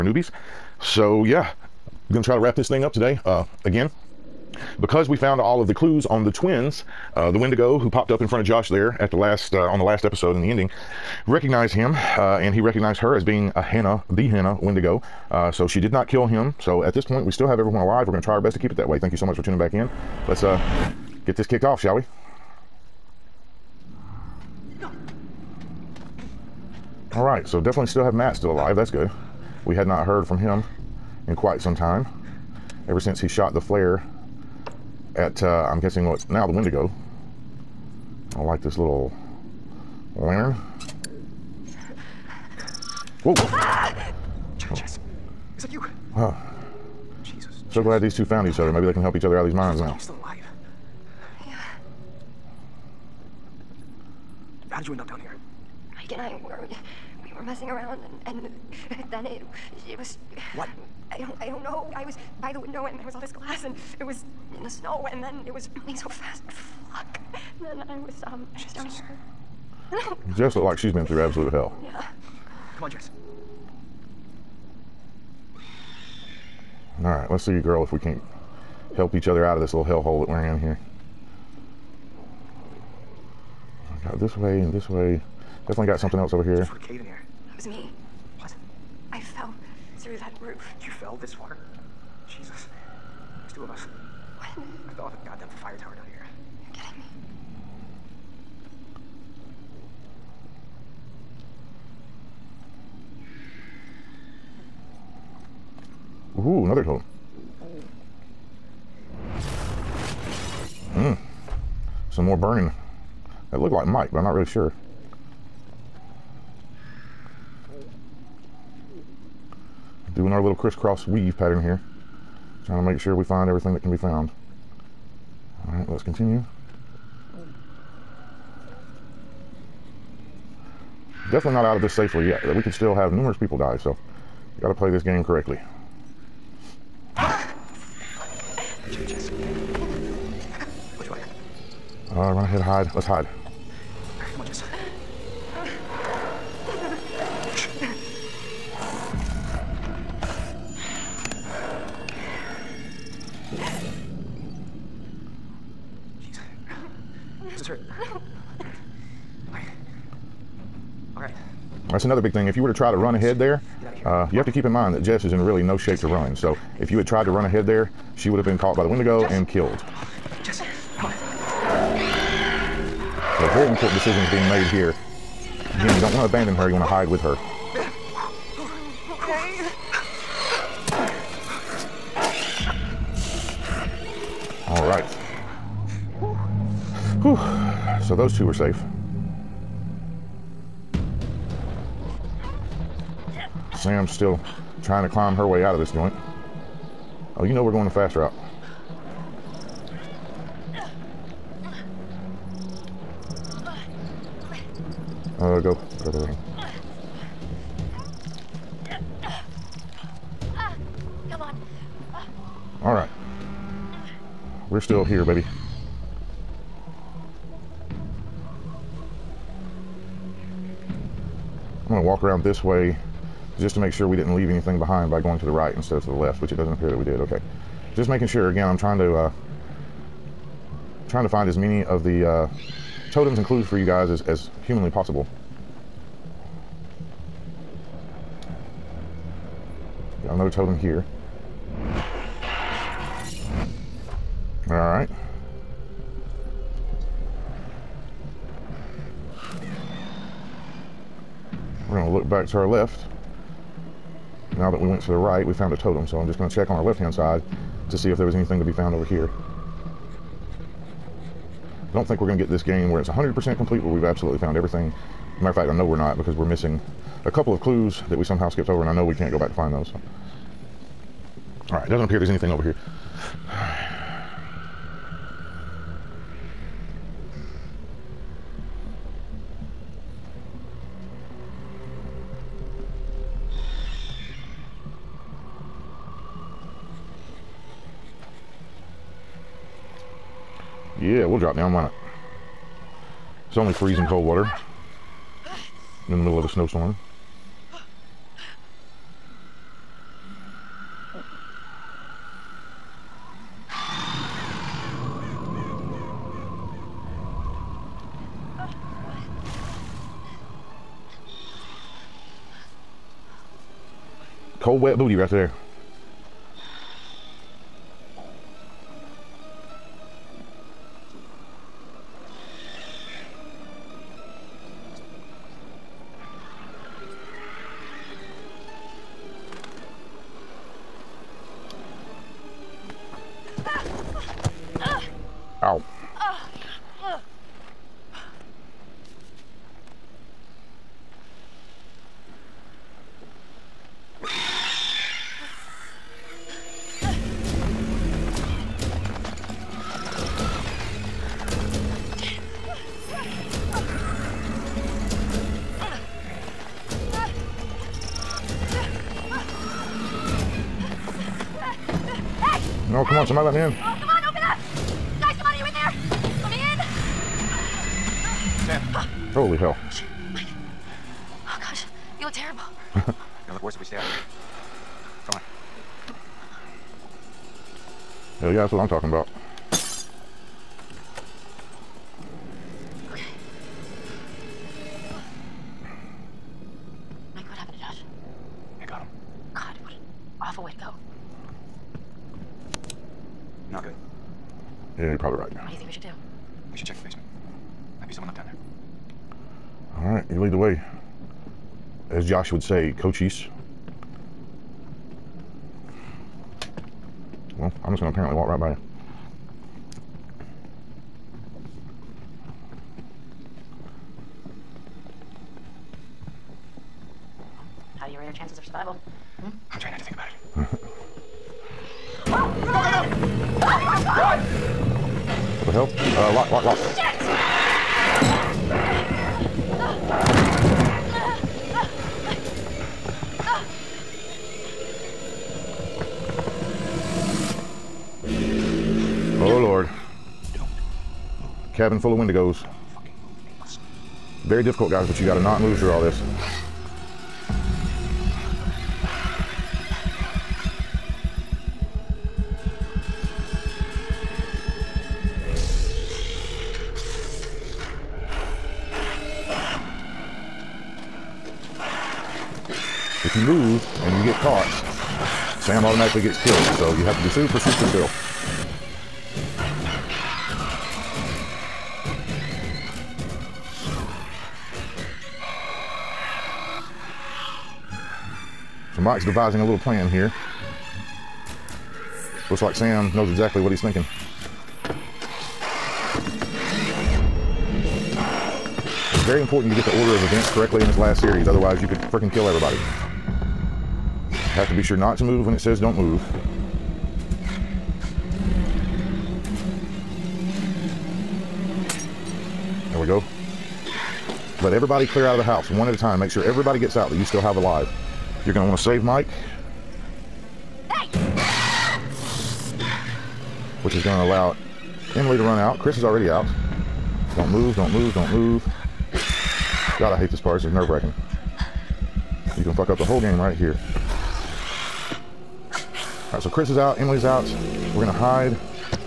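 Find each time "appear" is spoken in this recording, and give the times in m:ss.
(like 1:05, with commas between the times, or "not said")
3:46, 4:32.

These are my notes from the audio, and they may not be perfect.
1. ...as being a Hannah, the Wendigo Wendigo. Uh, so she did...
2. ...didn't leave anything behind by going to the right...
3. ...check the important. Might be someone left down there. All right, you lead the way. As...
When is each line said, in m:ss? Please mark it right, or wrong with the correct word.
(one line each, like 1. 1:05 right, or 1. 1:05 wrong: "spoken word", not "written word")
1. 0:13 wrong: "Hannah", not "Wendigo"
2. 3:44 right
3. 6:36 wrong: "basement", not "important".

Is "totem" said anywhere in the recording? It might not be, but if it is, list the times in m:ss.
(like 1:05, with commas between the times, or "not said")
1:46, 3:53, 4:00, 4:15.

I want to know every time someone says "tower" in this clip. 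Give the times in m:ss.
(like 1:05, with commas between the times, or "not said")
1:35.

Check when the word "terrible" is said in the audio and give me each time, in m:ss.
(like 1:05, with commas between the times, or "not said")
6:12.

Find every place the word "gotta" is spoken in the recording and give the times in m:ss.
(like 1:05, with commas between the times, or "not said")
2:14, 7:25.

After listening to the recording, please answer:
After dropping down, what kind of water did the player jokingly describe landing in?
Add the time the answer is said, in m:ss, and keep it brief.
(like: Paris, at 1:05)
freezing cold water, at 4:53.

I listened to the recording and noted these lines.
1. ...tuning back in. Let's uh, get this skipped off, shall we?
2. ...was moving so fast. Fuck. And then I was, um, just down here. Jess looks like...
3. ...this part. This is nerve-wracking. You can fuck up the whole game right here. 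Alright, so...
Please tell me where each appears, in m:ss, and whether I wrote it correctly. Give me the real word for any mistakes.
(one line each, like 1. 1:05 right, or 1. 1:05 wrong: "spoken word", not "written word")
1. 0:19 wrong: "kicked", not "skipped"
2. 1:05 right
3. 8:40 right.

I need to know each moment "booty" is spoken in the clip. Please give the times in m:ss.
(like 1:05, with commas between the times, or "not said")
5:14.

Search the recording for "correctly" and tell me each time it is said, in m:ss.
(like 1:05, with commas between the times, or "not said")
2:15, 8:10.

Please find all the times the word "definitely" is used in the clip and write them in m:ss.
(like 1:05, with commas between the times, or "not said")
0:27, 1:25, 2:11.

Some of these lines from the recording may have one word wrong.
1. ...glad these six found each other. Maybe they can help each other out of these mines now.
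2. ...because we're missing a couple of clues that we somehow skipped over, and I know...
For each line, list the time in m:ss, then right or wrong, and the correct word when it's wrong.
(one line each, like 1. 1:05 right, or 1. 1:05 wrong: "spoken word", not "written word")
1. 0:47 wrong: "two", not "six"
2. 4:26 right.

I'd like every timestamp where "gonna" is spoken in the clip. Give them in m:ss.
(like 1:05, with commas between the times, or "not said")
3:41, 6:13.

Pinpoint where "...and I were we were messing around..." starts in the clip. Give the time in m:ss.
0:56.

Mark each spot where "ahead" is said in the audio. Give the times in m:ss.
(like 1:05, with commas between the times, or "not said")
2:22, 2:43, 2:47.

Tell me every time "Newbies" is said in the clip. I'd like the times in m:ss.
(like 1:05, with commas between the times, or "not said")
0:00.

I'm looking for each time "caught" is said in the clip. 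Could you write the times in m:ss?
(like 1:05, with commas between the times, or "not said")
2:48, 7:44.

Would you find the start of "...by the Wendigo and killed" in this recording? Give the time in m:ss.
2:48.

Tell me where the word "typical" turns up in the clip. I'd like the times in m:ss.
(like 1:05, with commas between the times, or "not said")
not said.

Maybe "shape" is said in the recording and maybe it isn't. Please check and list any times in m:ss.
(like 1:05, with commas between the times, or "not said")
2:45.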